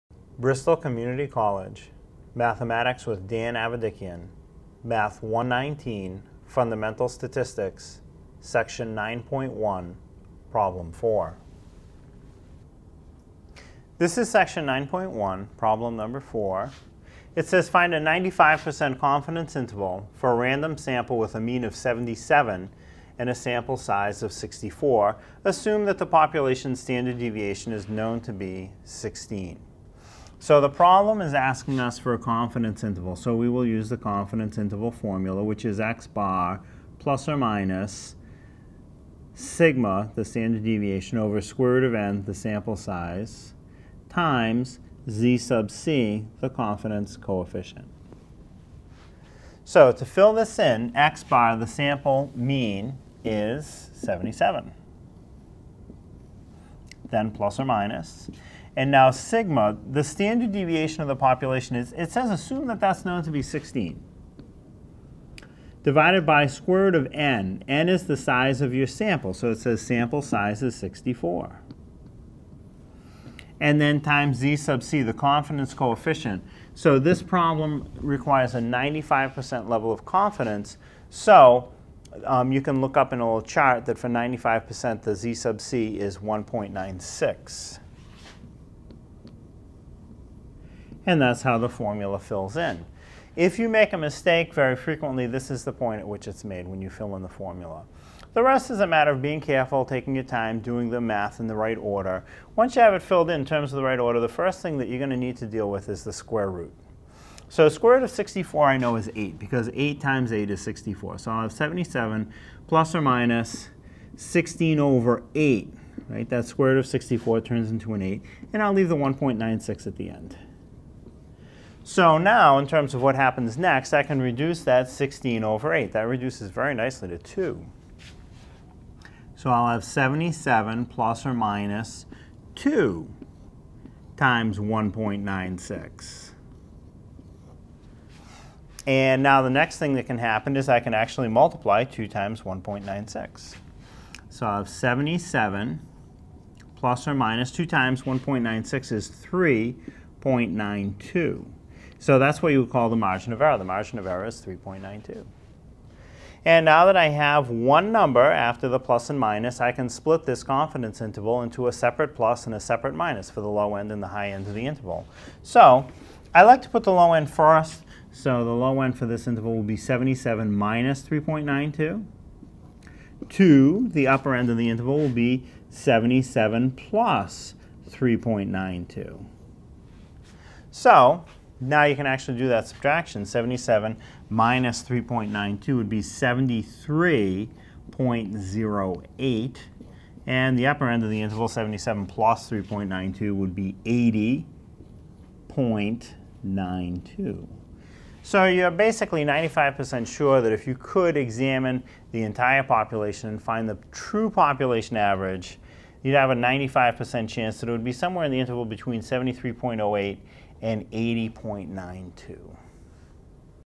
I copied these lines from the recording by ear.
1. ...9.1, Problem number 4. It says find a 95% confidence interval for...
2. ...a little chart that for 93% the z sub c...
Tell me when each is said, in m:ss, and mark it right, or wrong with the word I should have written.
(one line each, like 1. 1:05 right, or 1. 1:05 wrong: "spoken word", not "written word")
1. 0:14 right
2. 1:23 wrong: "95", not "93".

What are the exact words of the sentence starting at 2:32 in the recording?
So that's what you would call the margin of error.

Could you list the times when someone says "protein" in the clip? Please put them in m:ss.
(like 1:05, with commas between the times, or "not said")
not said.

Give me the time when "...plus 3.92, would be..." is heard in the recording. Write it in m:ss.
3:12.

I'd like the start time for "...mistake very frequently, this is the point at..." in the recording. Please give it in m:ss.
1:33.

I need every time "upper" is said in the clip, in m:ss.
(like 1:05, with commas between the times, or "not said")
2:54, 3:10.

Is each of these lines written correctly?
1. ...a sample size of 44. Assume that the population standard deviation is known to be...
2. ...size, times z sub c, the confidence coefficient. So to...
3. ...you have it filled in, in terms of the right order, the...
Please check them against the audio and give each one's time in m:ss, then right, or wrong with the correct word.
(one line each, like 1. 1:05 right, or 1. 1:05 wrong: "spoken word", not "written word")
1. 0:23 wrong: "64", not "44"
2. 0:42 right
3. 1:42 right.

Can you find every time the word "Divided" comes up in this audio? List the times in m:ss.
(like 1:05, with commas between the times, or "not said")
1:05.